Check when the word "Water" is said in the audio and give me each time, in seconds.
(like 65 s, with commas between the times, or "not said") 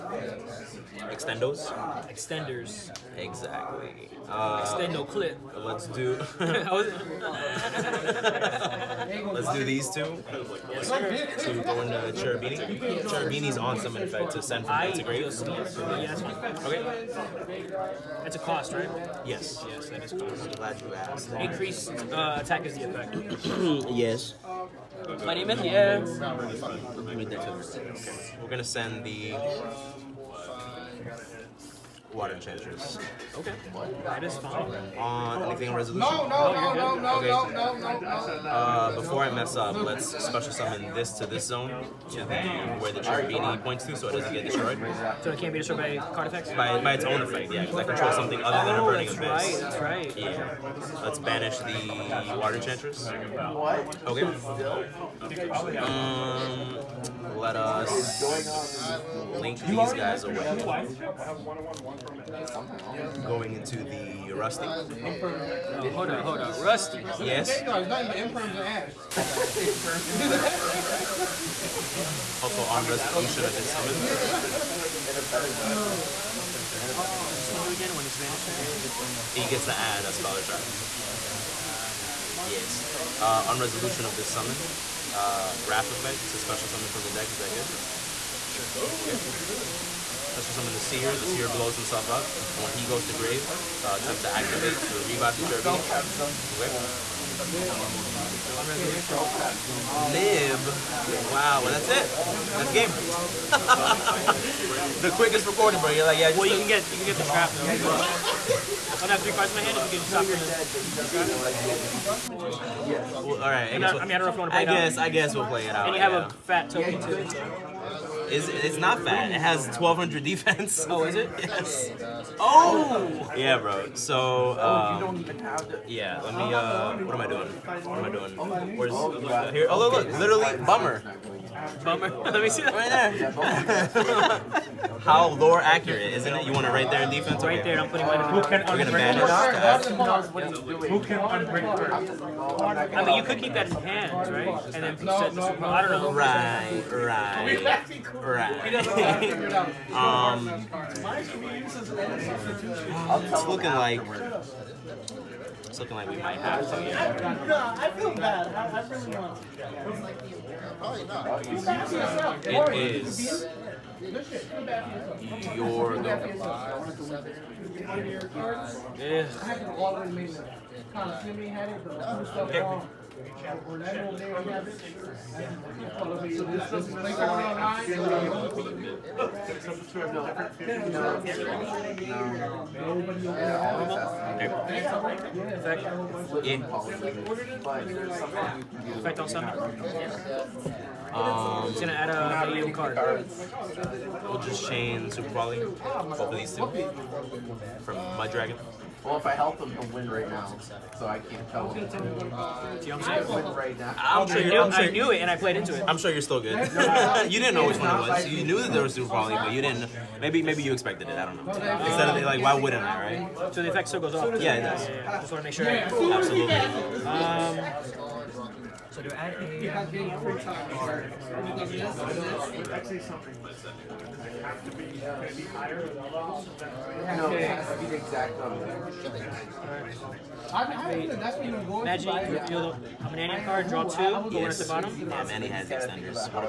32 s, 52 s.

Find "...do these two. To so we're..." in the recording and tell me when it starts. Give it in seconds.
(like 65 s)
9 s.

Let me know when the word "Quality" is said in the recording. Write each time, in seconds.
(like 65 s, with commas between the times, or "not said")
195 s.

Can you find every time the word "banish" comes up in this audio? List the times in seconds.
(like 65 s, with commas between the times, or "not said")
51 s.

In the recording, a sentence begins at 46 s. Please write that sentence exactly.
By, by its own effect, yeah, because I control oh, something other than a Burning Abyss.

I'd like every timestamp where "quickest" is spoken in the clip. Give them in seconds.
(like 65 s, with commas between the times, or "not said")
105 s.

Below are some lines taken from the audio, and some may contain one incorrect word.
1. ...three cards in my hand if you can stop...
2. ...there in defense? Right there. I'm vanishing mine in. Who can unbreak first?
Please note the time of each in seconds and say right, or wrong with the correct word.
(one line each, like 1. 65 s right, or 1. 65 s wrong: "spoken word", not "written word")
1. 109 s right
2. 136 s wrong: "putting", not "vanishing".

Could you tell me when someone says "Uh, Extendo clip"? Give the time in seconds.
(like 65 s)
4 s.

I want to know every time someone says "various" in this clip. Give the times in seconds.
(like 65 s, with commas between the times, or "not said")
not said.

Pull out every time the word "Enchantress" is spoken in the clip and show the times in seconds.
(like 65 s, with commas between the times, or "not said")
32 s, 52 s.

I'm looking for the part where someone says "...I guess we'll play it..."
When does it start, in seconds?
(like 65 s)
114 s.